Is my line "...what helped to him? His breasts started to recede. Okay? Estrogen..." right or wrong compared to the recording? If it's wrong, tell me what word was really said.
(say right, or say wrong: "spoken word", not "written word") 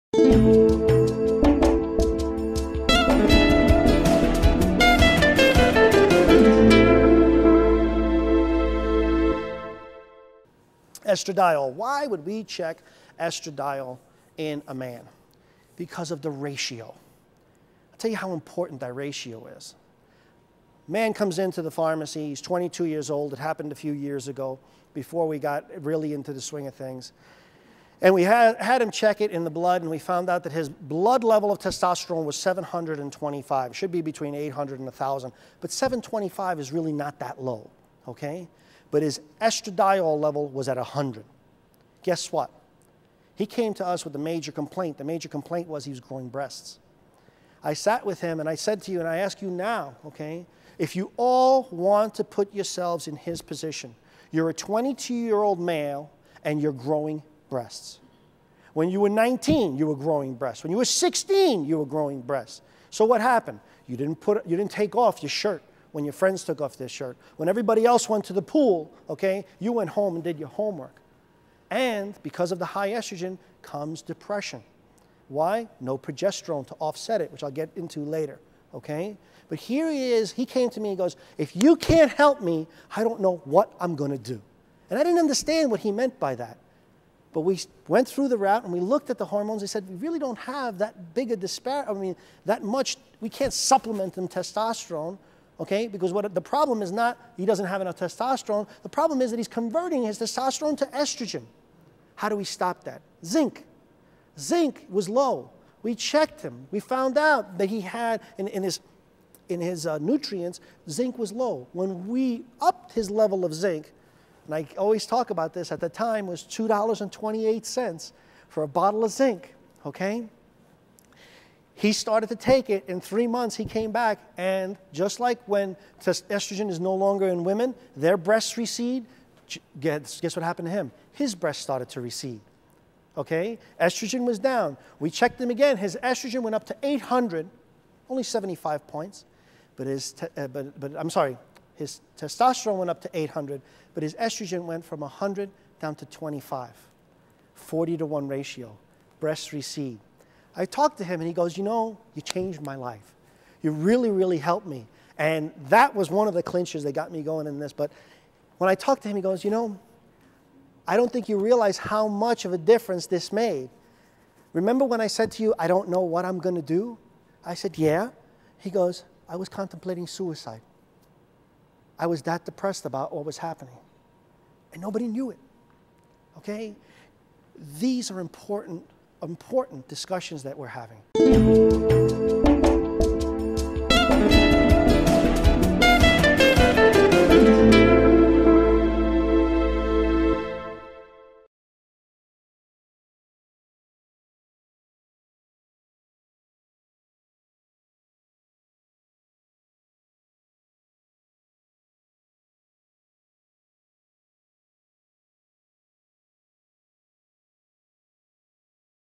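wrong: "happened", not "helped".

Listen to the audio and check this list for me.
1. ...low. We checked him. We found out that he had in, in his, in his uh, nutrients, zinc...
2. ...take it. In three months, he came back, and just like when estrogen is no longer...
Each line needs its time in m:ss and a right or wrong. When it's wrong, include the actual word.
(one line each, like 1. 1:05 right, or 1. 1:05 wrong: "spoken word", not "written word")
1. 1:45 right
2. 2:02 right.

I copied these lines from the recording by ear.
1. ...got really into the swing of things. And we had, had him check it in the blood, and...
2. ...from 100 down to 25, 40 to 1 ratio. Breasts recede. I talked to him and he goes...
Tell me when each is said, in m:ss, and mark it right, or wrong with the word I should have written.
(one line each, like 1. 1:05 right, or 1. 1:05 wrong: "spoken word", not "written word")
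1. 0:25 right
2. 2:24 right.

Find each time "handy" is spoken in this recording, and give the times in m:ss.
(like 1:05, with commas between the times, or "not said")
not said.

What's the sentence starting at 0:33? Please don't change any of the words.
It should be between 800 and 1,000, but 725 is really not that low, okay?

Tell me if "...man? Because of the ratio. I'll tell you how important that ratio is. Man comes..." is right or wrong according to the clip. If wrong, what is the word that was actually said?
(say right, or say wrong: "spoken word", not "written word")
right.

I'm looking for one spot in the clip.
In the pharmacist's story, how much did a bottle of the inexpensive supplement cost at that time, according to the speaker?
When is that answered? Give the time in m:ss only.
1:56.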